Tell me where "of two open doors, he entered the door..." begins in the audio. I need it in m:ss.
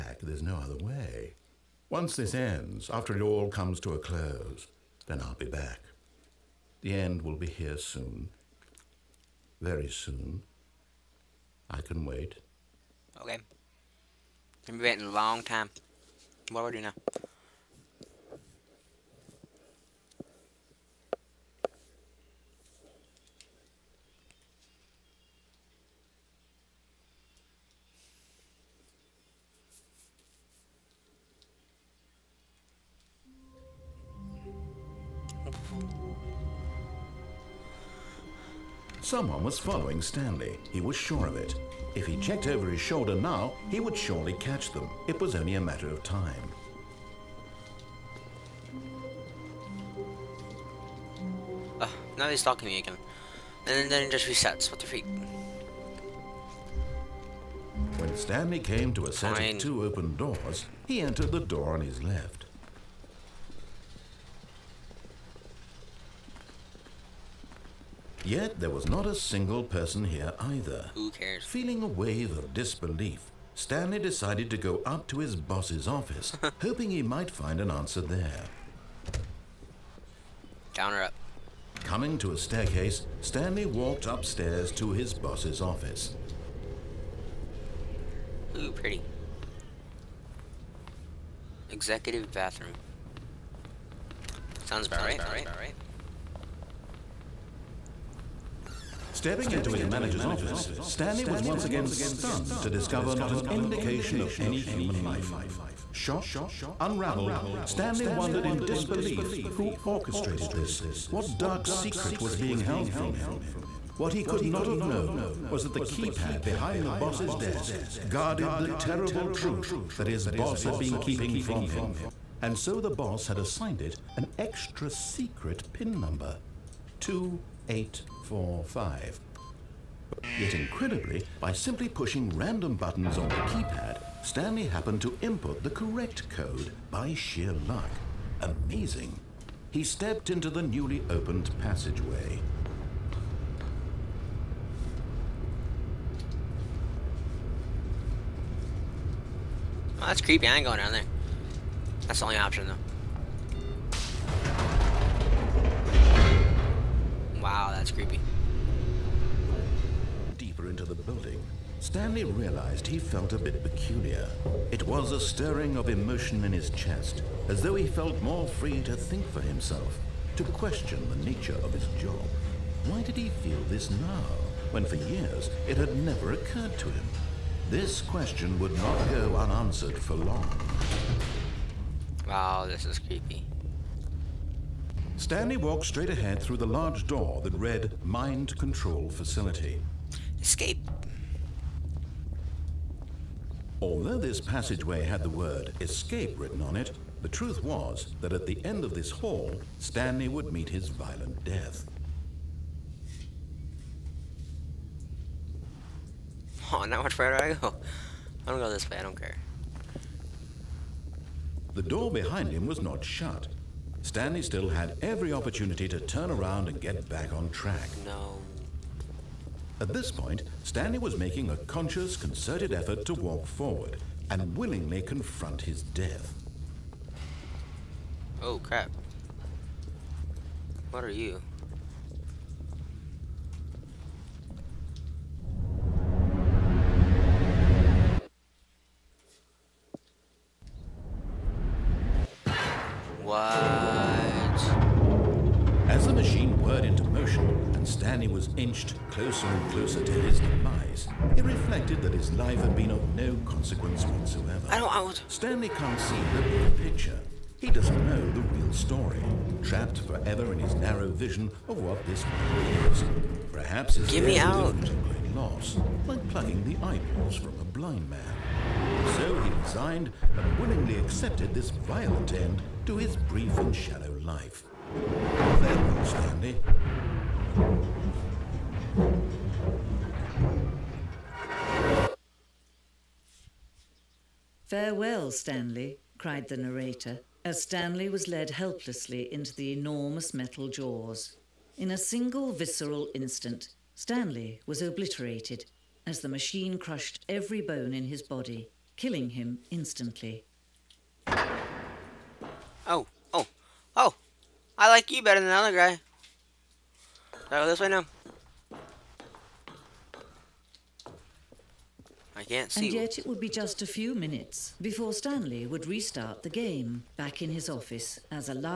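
0:59.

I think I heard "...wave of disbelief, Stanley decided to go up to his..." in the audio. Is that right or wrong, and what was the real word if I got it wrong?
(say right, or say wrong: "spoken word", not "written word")
right.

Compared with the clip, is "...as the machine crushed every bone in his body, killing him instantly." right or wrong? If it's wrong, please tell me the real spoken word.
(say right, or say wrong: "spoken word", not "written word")
right.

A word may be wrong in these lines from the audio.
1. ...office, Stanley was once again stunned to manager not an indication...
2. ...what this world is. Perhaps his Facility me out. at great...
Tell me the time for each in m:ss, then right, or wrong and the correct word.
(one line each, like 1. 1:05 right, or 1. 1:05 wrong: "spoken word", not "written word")
1. 1:40 wrong: "discover", not "manager"
2. 4:21 wrong: "Give", not "Facility".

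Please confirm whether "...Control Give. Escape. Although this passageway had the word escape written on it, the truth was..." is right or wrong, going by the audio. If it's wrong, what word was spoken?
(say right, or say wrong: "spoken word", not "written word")
wrong: "Facility", not "Give".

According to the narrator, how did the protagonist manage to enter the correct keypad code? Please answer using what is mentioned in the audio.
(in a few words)
By sheer luck.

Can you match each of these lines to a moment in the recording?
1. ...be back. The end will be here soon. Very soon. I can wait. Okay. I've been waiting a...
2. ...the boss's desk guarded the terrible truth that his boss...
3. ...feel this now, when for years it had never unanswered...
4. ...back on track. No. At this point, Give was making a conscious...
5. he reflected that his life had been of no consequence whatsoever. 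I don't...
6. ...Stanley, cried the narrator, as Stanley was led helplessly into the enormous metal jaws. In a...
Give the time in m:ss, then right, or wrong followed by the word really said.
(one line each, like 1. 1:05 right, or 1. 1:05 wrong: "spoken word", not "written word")
1. 0:05 right
2. 1:56 right
3. 2:53 wrong: "occurred", not "unanswered"
4. 3:37 wrong: "Stanley", not "Give"
5. 4:11 right
6. 4:45 right.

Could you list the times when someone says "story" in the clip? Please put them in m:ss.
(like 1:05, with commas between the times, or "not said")
4:18.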